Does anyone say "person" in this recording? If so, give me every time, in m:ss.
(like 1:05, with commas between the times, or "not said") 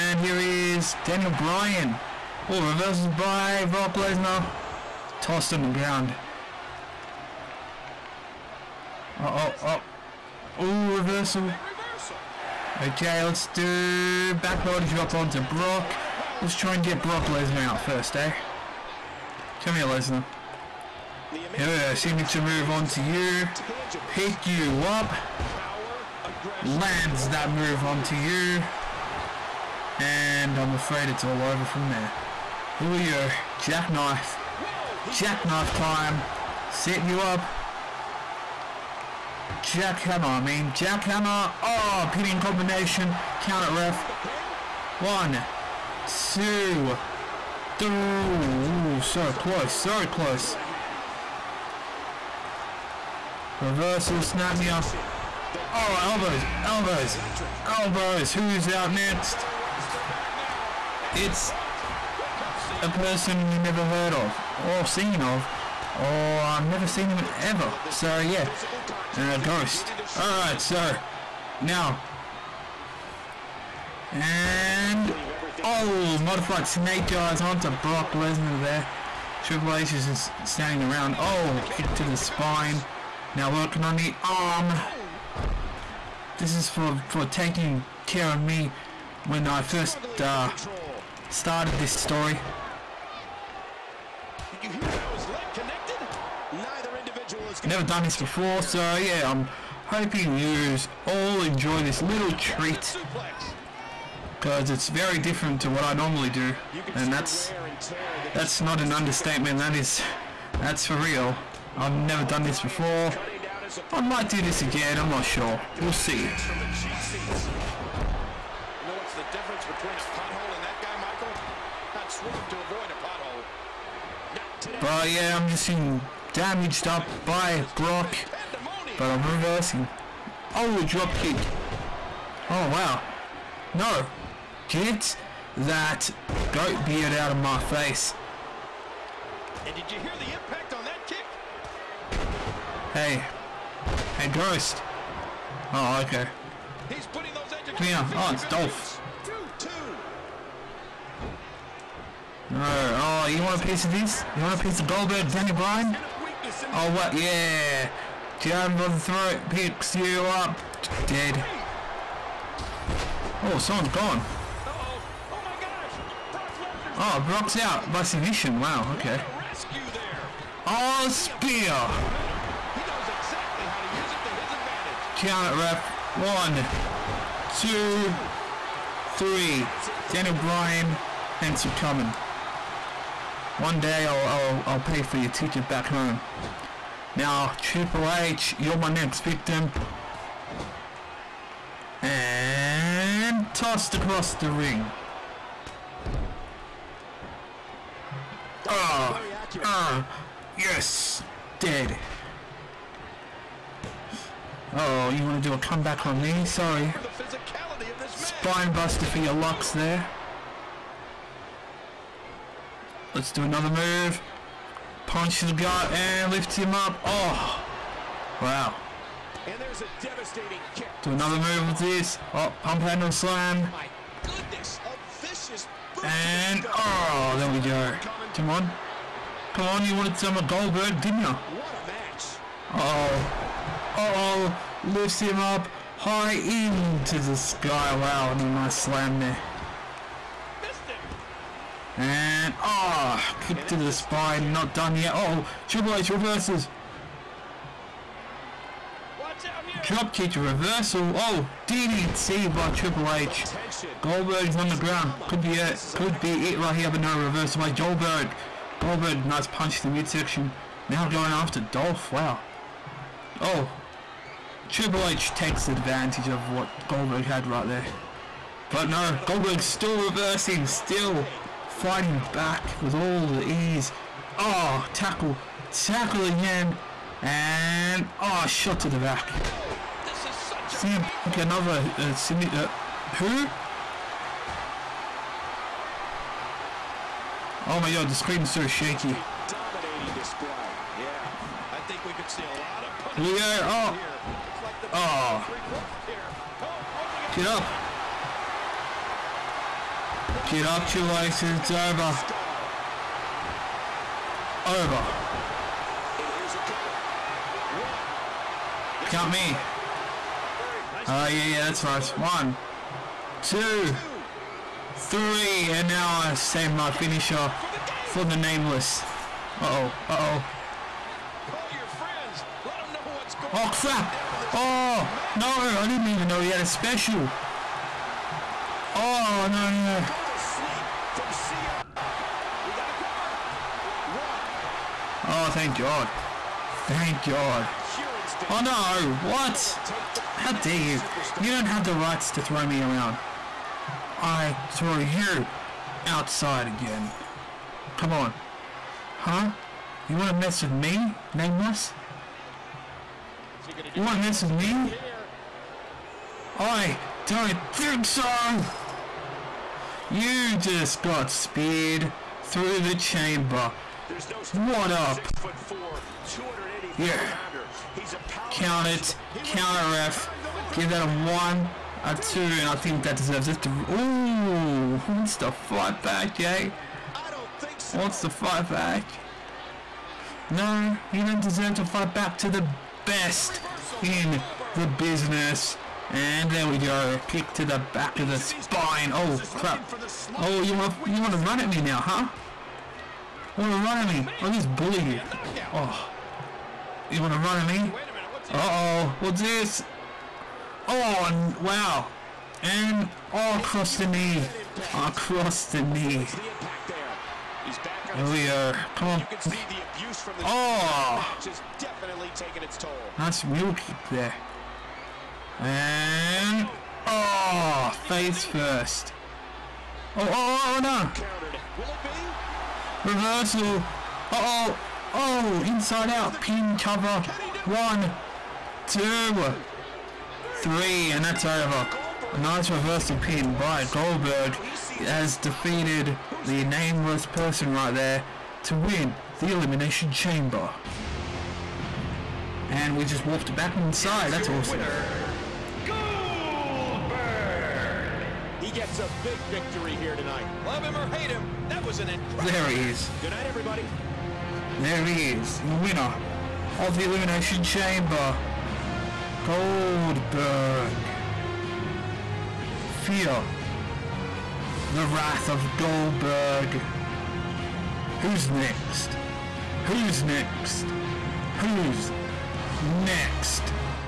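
1:02, 7:17.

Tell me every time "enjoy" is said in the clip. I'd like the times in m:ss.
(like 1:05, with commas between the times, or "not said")
1:41.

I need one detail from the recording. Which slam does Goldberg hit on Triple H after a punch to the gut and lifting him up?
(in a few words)
Pump handle slam.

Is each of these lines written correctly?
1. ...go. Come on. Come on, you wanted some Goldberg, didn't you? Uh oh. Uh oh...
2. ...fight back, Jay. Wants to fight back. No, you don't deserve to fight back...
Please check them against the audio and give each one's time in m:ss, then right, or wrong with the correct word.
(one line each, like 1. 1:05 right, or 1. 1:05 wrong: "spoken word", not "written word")
1. 3:47 right
2. 6:15 right.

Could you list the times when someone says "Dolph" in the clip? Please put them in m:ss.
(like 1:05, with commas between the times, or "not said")
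2:28, 4:21.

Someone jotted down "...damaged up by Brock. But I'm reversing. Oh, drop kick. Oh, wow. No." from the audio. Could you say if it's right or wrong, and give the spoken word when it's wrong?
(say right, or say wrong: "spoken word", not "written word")
right.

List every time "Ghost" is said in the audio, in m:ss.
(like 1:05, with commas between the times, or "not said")
1:09, 2:24.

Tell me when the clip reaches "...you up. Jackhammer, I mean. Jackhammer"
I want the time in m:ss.
0:37.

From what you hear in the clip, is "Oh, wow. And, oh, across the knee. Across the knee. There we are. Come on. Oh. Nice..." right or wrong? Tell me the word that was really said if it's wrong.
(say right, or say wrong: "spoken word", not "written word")
right.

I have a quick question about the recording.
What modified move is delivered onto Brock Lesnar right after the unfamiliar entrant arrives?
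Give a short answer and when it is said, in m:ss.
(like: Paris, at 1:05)
Modified snake eyes, at 1:16.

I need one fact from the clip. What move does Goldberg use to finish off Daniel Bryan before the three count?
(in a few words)
Spear.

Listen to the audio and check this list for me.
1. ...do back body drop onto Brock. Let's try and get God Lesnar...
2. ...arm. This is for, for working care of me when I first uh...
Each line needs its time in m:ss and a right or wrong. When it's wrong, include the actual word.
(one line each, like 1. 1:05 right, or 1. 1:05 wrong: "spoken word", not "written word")
1. 0:13 wrong: "Brock", not "God"
2. 1:24 wrong: "taking", not "working".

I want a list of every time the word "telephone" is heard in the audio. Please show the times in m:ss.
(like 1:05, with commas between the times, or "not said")
not said.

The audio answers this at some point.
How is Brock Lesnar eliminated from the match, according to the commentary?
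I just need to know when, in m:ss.
2:47.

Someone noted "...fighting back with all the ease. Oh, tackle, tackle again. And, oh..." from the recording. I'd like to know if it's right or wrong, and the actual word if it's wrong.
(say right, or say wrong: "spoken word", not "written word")
right.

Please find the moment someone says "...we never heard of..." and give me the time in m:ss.
1:03.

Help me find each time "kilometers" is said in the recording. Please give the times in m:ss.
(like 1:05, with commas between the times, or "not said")
not said.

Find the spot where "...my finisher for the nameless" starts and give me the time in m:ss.
5:16.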